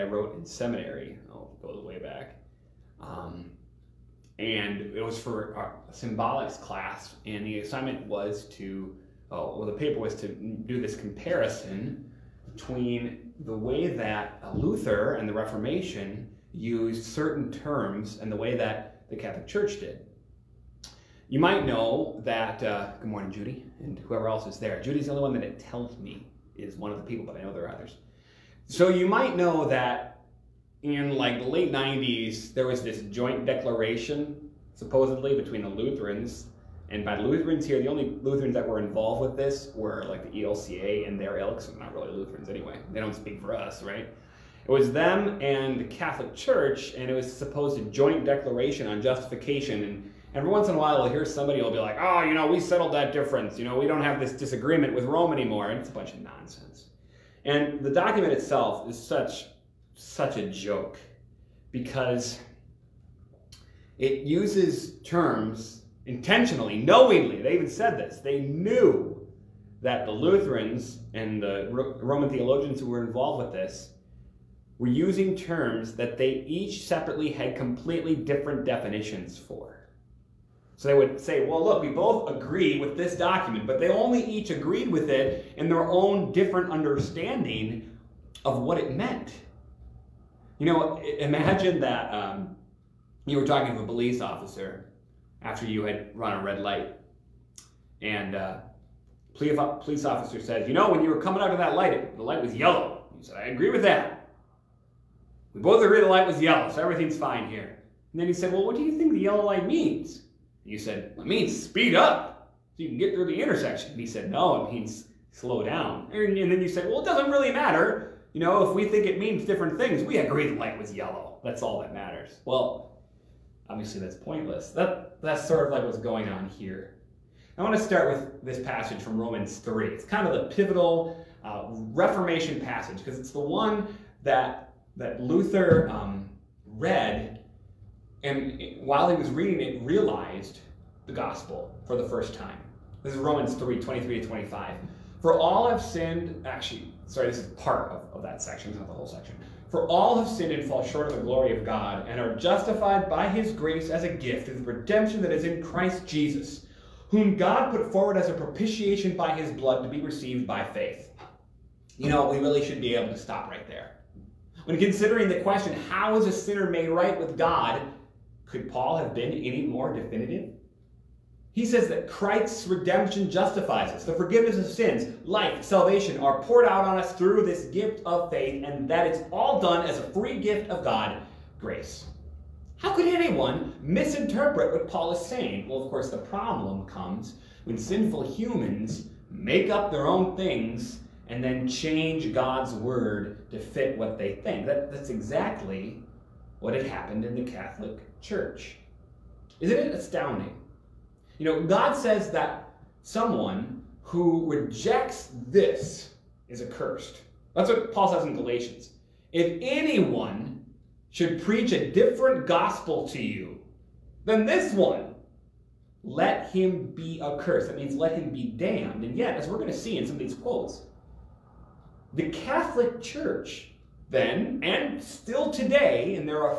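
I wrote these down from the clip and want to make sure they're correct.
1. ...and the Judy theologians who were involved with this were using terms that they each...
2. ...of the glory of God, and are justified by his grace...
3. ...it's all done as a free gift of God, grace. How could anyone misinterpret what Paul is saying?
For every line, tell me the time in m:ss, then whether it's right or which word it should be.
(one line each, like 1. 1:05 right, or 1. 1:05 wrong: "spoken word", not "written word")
1. 1:11 wrong: "Roman", not "Judy"
2. 2:31 right
3. 2:59 right.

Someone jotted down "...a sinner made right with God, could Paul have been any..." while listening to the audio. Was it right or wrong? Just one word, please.
right.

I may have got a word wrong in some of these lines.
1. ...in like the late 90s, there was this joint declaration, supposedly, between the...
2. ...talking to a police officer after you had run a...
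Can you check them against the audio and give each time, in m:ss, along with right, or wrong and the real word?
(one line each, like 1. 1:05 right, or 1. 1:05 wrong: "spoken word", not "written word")
1. 0:30 right
2. 1:33 right.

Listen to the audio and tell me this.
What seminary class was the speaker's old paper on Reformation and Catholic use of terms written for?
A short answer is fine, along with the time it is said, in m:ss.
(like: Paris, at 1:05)
Symbolics, at 0:05.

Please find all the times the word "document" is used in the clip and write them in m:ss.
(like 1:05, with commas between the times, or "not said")
0:57, 1:23.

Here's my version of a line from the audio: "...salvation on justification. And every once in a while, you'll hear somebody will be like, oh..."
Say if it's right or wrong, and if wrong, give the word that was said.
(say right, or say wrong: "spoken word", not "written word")
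wrong: "declaration", not "salvation".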